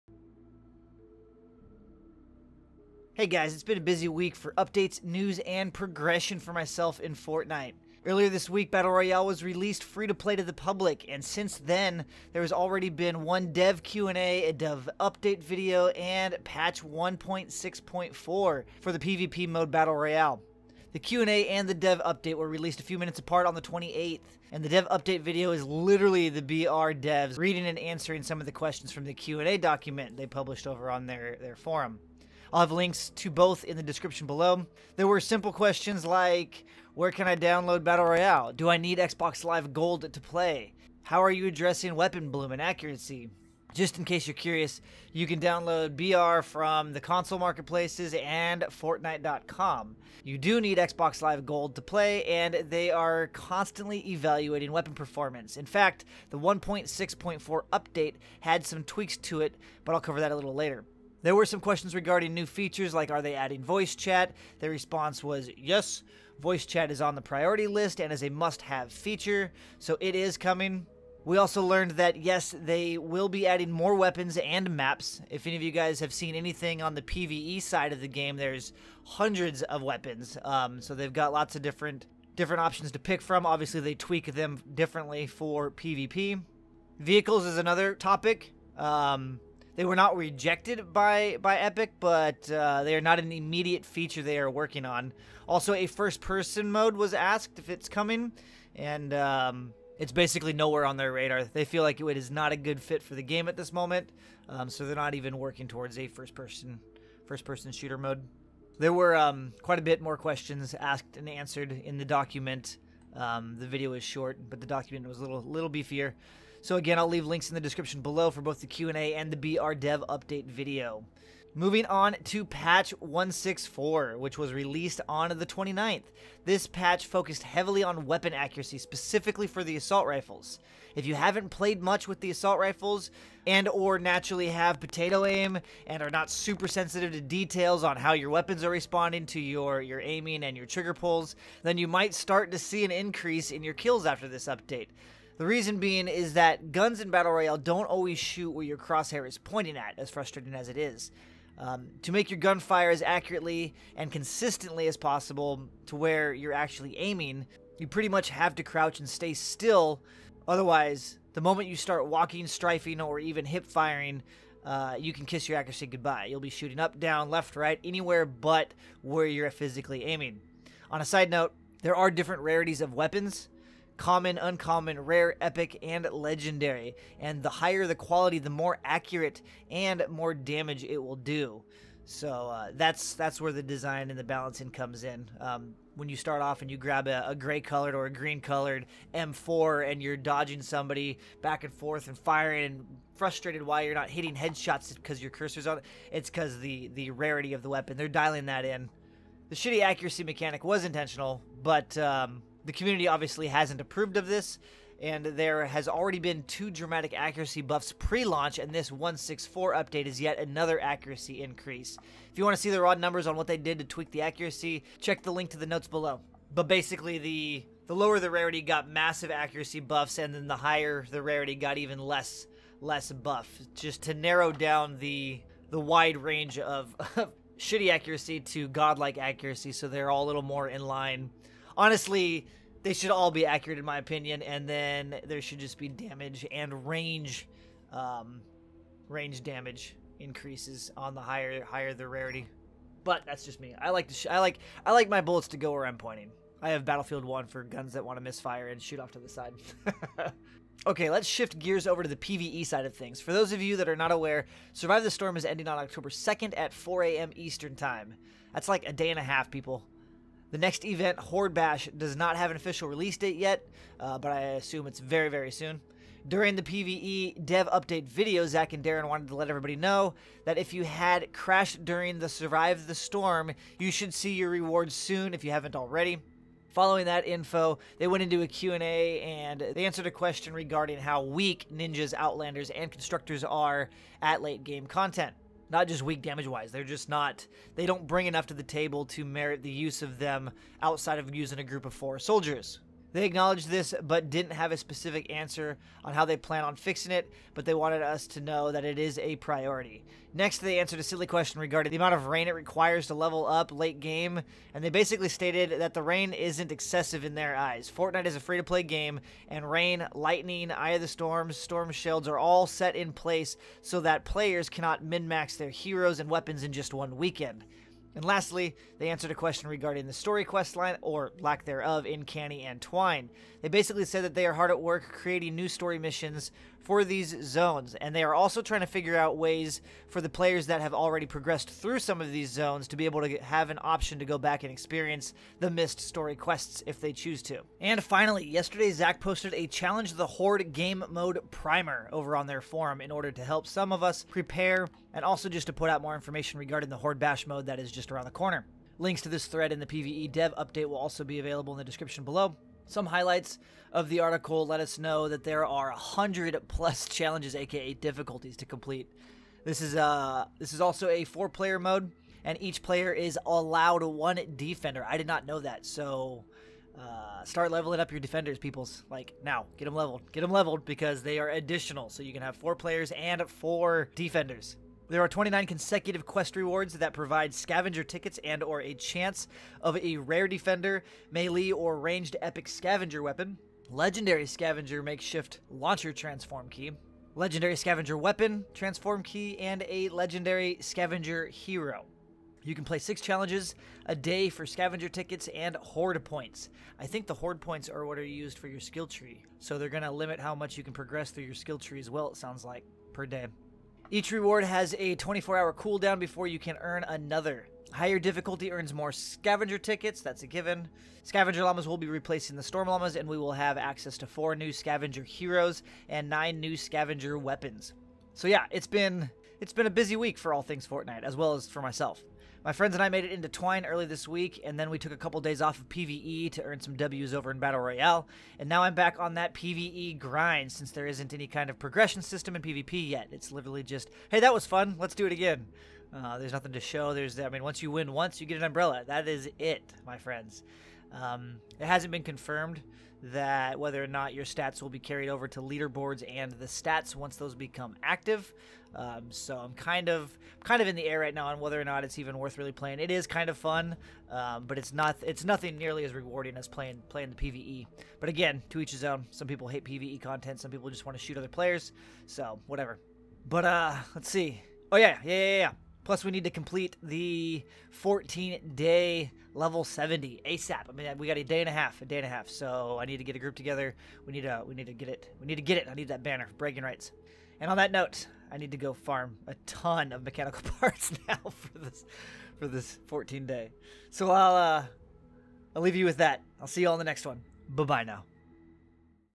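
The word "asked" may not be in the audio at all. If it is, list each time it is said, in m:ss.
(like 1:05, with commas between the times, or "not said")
1:37, 1:50.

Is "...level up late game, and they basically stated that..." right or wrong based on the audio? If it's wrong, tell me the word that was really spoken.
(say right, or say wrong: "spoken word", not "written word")
right.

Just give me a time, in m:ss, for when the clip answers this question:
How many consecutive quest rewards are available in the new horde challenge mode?
6:15.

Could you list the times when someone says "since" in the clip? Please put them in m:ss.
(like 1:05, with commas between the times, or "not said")
0:11, 7:10.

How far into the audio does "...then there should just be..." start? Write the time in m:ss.
3:54.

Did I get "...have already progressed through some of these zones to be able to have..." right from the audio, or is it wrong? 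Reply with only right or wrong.
right.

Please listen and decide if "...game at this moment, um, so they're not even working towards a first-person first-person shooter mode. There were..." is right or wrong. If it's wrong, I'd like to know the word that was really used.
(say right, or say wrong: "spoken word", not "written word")
right.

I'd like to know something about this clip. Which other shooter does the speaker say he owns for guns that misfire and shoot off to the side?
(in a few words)
Battlefield 1.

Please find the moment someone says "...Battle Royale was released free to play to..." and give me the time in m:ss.
0:08.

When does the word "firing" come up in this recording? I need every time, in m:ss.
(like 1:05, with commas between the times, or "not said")
2:43, 3:12.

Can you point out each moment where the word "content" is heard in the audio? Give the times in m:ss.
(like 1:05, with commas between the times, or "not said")
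4:44, 7:40.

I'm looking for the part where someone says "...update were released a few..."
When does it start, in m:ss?
0:22.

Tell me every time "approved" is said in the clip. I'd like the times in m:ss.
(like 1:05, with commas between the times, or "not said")
3:23.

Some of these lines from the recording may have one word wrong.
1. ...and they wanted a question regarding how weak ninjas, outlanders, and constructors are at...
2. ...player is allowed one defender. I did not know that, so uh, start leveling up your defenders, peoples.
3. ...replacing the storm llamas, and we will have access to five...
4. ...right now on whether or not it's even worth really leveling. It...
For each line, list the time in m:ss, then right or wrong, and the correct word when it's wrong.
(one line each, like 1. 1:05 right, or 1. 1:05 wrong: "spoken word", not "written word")
1. 4:39 wrong: "answered", not "wanted"
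2. 6:02 right
3. 6:52 wrong: "four", not "five"
4. 7:31 wrong: "playing", not "leveling".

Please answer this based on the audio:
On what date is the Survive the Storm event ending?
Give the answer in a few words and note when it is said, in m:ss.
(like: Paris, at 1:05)
October 2nd, at 4:15.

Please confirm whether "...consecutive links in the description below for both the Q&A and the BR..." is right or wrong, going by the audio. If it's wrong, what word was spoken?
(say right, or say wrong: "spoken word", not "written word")
wrong: "leave", not "consecutive".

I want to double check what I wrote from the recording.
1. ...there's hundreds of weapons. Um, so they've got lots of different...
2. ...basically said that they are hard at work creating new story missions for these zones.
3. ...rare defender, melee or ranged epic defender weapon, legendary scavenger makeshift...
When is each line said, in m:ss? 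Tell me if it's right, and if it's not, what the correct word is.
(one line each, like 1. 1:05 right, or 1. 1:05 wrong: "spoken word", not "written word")
1. 1:18 right
2. 5:23 right
3. 6:20 wrong: "scavenger", not "defender".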